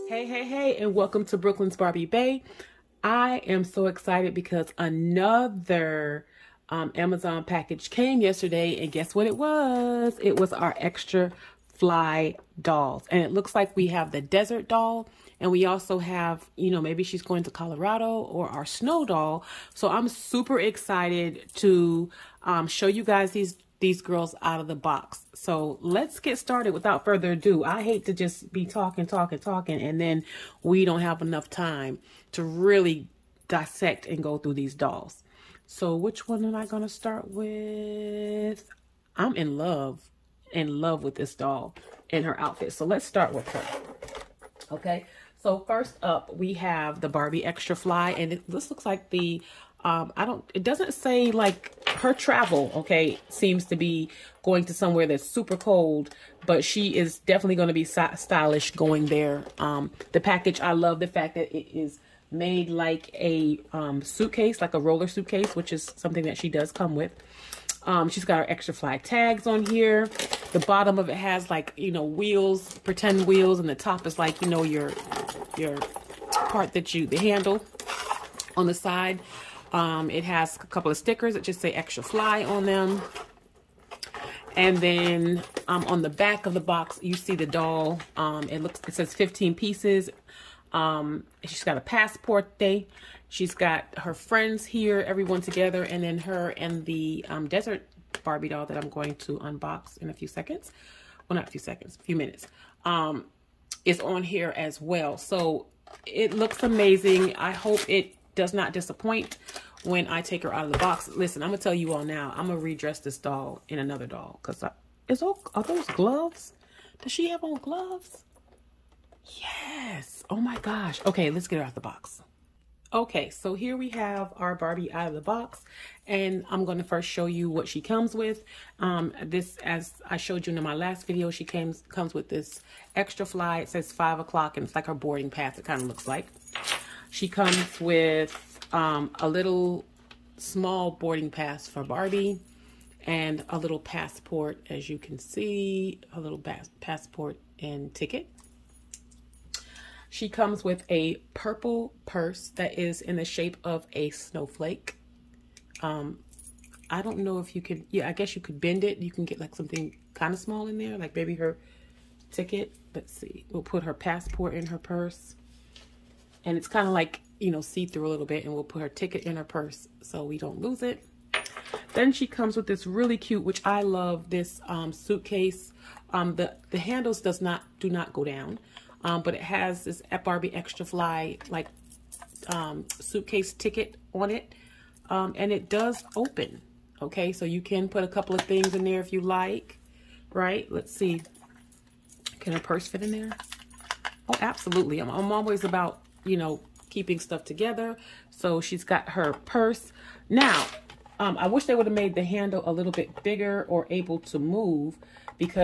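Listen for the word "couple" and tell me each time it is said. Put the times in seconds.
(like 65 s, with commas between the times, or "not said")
80 s, 188 s.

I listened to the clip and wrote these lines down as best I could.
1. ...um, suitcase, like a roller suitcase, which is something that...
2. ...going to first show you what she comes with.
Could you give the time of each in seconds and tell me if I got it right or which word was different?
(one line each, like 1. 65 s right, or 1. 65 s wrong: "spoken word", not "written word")
1. 63 s right
2. 126 s right.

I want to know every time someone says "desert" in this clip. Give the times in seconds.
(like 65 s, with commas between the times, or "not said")
14 s, 97 s.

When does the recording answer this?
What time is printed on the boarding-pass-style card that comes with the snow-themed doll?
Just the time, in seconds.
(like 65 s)
133 s.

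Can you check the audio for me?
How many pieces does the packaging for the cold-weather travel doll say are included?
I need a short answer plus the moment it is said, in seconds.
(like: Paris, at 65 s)
15, at 89 s.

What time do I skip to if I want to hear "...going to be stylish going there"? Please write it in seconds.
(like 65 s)
57 s.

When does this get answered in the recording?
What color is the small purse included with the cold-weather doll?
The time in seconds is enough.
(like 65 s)
151 s.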